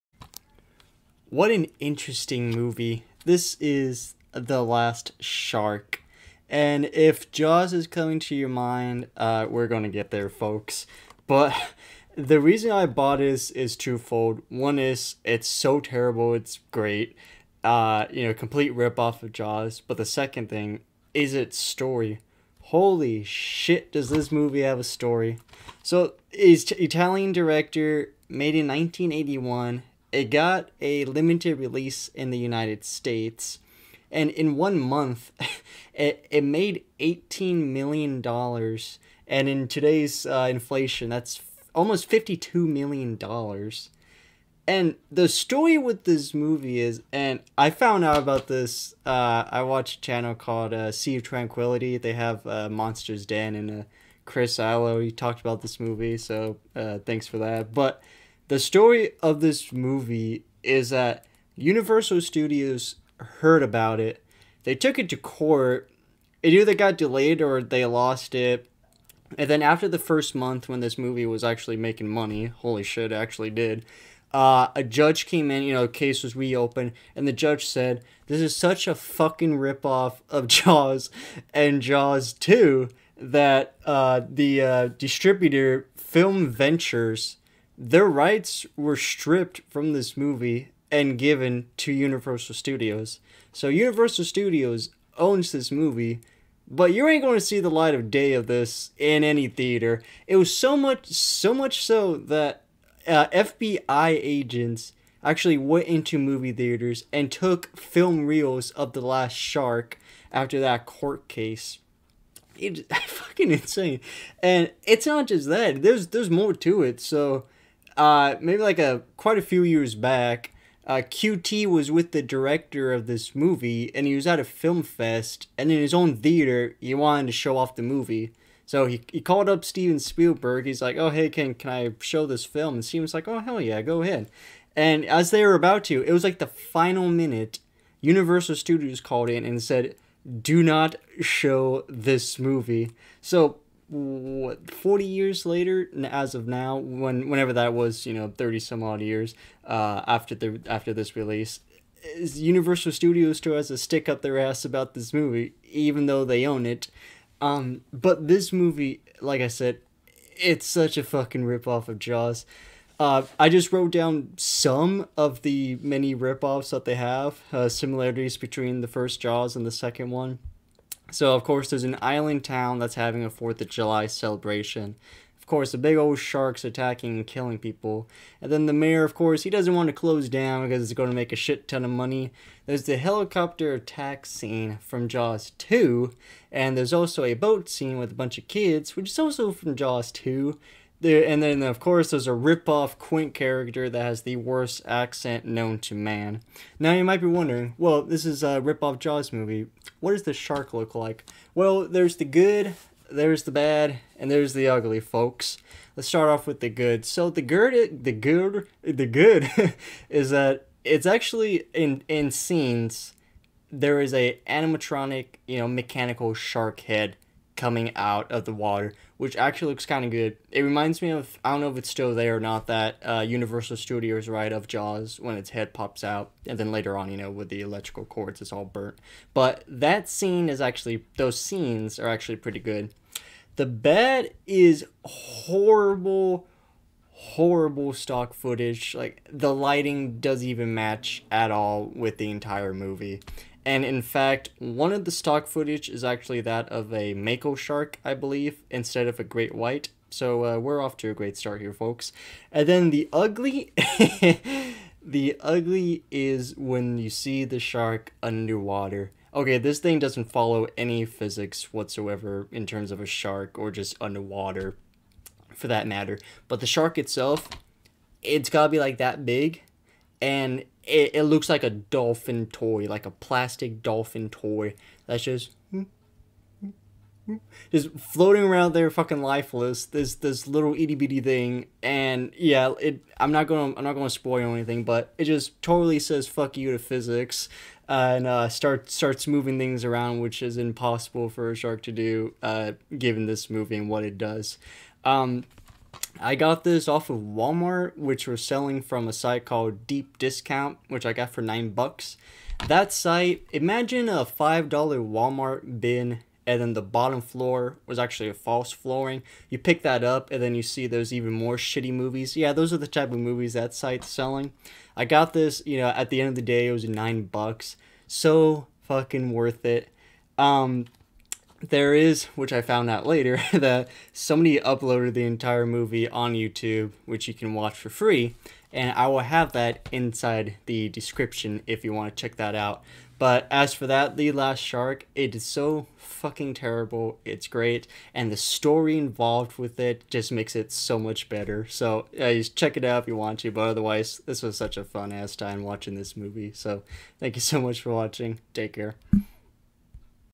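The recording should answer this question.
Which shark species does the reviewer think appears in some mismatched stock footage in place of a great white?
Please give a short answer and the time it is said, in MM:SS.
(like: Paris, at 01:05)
Mako shark, at 04:07.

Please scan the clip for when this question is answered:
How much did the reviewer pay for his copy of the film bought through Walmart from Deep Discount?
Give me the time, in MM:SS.
05:01.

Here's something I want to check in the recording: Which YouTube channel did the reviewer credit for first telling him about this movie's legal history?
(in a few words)
Sea of Tranquility.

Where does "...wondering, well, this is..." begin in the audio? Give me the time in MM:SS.
03:17.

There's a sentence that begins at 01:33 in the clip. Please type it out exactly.
So Universal Studios owns this movie, but you ain't going to see the light of day of this in any theater.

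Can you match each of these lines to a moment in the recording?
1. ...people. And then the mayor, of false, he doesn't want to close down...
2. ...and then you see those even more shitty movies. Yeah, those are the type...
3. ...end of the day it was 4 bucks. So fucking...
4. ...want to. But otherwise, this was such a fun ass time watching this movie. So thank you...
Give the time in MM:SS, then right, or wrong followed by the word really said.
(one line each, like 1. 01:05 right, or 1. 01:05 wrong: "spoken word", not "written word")
1. 02:57 wrong: "course", not "false"
2. 05:10 right
3. 05:16 wrong: "9", not "4"
4. 05:43 right.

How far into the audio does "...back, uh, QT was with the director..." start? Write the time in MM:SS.
01:59.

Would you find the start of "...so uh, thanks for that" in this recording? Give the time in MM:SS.
00:56.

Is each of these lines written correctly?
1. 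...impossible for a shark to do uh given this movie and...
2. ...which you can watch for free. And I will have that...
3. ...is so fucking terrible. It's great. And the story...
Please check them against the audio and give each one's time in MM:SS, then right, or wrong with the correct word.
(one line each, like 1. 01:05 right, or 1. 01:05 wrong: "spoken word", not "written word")
1. 04:50 right
2. 05:27 right
3. 05:35 right.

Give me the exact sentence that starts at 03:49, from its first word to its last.
But that scene is actually, those scenes are actually pretty good.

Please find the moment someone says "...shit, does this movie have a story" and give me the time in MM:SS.
00:23.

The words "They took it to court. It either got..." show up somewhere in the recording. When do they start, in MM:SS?
01:04.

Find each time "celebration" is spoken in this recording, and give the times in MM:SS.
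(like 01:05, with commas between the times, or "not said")
02:54.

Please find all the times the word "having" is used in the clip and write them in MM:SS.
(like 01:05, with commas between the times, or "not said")
02:52.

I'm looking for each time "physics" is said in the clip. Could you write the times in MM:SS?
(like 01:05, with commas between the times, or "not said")
04:21, 04:46.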